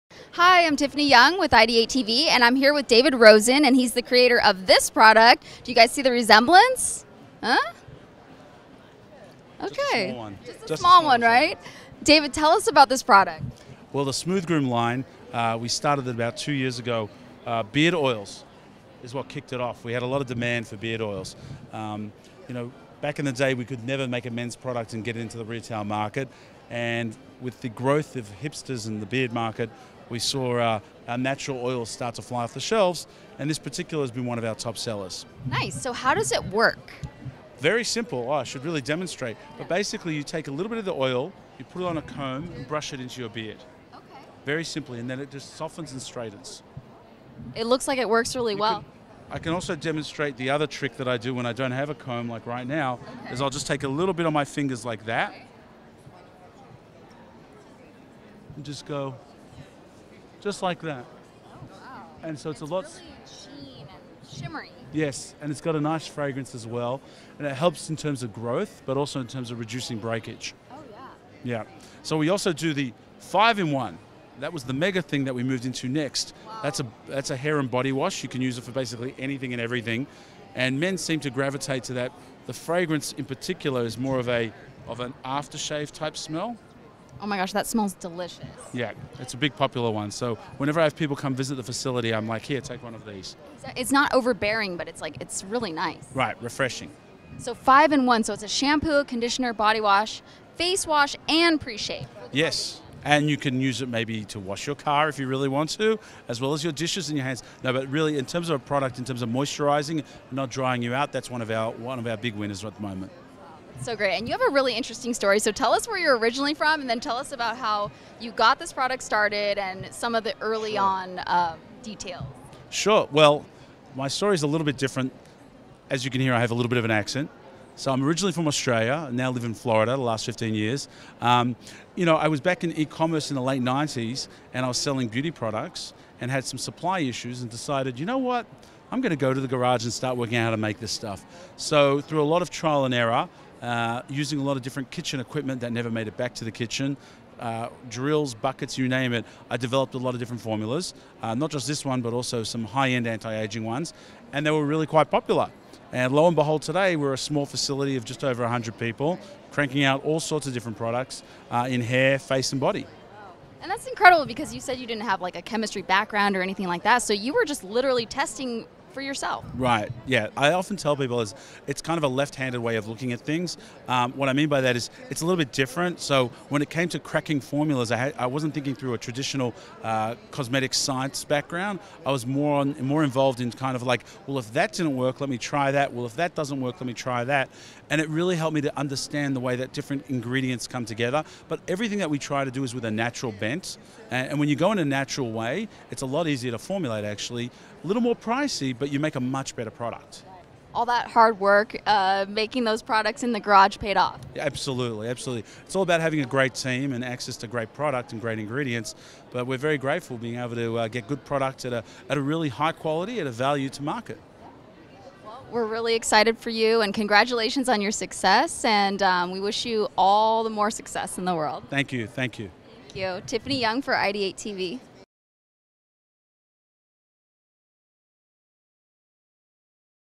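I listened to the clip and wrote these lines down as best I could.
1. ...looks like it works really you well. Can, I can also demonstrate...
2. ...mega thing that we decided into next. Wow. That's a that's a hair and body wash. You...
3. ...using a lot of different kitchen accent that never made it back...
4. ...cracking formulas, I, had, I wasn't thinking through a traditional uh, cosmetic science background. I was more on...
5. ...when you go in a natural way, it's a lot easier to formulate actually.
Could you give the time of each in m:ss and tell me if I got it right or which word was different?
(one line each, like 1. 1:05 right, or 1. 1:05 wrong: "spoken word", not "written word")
1. 0:47 right
2. 1:14 wrong: "moved", not "decided"
3. 2:24 wrong: "equipment", not "accent"
4. 2:56 right
5. 3:14 right.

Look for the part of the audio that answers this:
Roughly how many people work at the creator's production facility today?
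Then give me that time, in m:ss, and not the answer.
2:38.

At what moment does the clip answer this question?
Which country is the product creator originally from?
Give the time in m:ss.
2:08.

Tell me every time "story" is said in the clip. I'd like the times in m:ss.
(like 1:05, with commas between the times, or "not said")
1:55, 2:04.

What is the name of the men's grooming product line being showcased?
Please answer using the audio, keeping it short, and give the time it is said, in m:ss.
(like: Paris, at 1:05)
Smooth Groom, at 0:14.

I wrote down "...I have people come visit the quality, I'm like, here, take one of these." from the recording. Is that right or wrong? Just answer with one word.
wrong.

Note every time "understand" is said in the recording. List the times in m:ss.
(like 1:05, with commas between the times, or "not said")
3:08.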